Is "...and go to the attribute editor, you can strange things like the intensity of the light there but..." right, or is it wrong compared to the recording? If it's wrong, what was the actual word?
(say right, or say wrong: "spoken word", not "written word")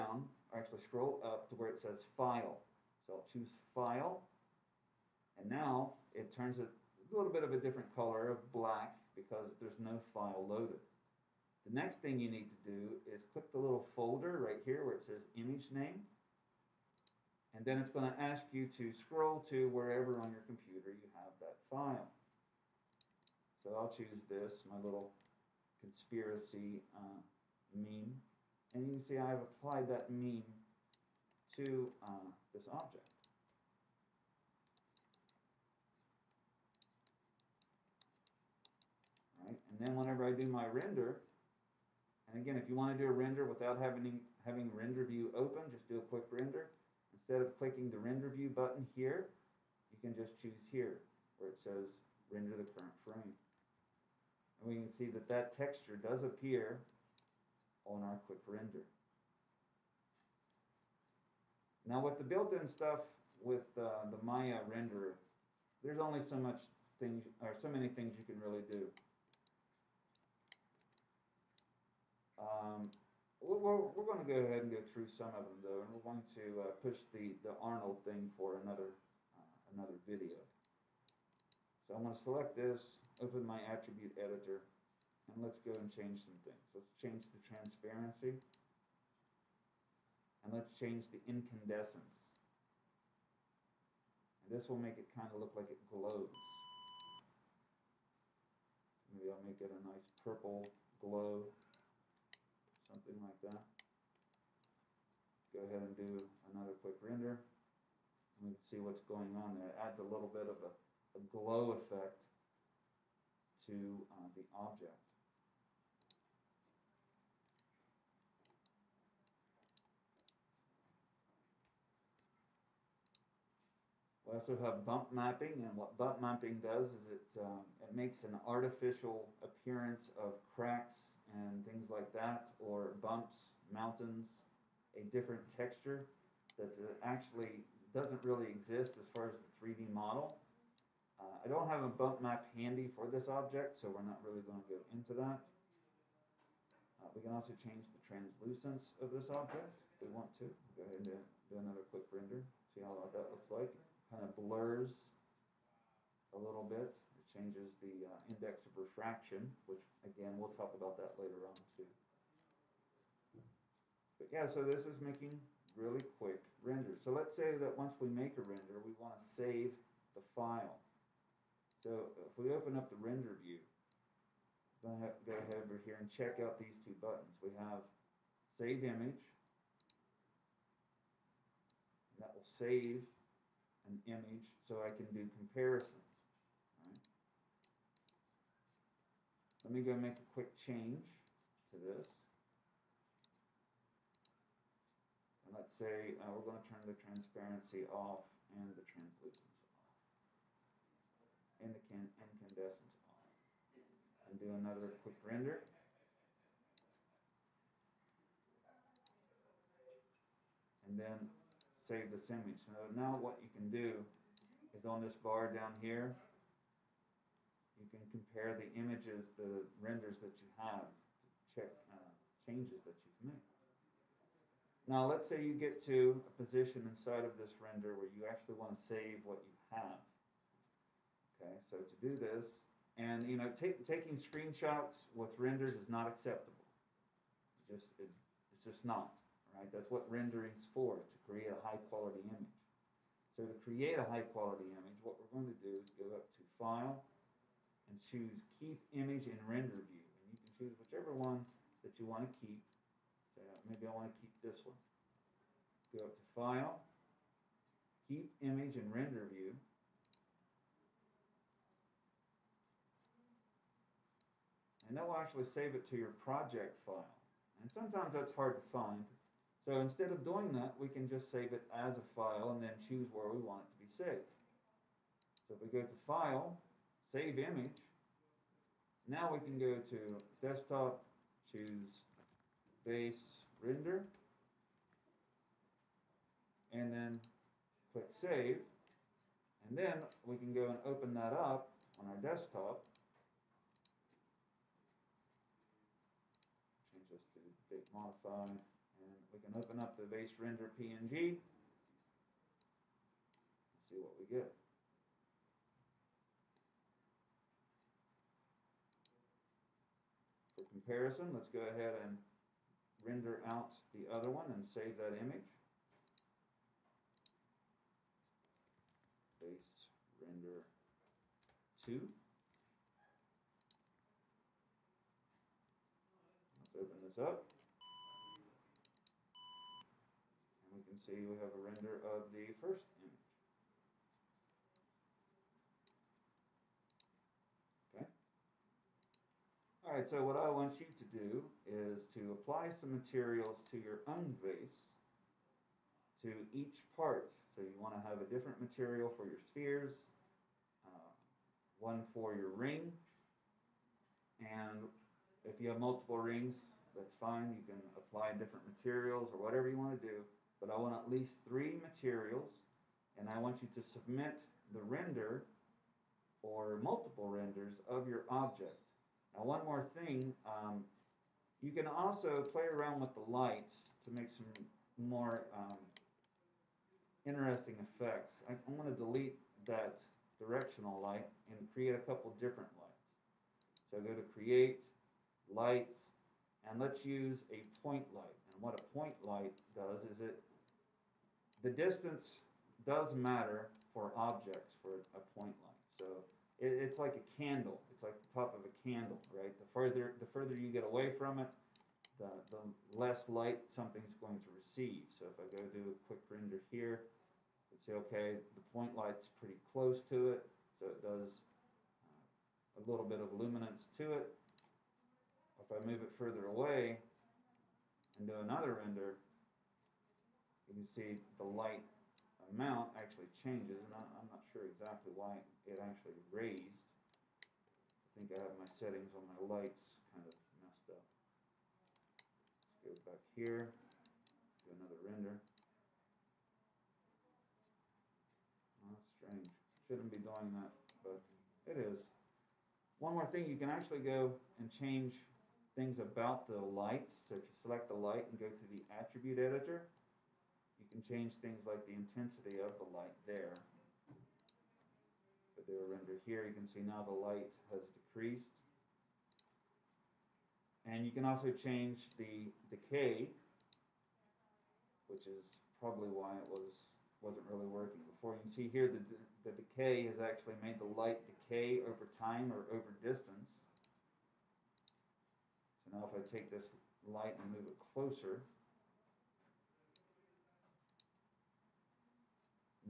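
wrong: "change", not "strange".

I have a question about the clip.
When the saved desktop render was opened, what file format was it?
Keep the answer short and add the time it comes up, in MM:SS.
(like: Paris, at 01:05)
PNG, at 05:00.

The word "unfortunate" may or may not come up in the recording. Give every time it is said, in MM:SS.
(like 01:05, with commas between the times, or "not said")
not said.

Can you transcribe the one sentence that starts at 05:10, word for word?
comparison, let's go ahead and render out the other one and save that image.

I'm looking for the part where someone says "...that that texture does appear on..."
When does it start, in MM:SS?
00:55.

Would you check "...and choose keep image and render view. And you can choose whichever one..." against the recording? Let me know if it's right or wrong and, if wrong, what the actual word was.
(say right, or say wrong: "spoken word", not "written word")
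right.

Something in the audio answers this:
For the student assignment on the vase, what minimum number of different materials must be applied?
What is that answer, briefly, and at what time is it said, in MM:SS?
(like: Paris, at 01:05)
3, at 06:01.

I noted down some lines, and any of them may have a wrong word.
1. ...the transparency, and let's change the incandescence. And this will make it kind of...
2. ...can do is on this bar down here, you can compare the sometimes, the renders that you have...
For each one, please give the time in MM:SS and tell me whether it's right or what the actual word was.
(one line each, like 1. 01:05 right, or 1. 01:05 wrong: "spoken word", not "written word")
1. 01:27 right
2. 03:33 wrong: "images", not "sometimes".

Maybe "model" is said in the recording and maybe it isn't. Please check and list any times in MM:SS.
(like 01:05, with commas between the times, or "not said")
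02:19.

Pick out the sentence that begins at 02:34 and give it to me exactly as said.
Kind of blurs a little bit changes the uh, index of refraction, which again, we'll talk about that later on too.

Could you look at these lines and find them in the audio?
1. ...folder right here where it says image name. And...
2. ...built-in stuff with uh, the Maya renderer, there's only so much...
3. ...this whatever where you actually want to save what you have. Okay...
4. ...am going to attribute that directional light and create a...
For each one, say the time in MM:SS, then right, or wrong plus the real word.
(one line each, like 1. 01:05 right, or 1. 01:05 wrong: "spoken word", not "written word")
1. 00:13 right
2. 01:02 right
3. 03:47 wrong: "render", not "whatever"
4. 06:18 wrong: "delete", not "attribute".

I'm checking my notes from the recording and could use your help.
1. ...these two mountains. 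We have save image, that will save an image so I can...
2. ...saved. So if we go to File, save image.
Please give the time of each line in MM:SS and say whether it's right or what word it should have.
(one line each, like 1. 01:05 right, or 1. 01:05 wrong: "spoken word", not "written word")
1. 02:56 wrong: "buttons", not "mountains"
2. 04:34 right.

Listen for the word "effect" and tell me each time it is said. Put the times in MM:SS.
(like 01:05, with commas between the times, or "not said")
01:51, 06:17.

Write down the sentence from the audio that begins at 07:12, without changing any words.
Let's go back here, do another render.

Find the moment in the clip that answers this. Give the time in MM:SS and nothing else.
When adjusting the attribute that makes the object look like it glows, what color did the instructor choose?
01:40.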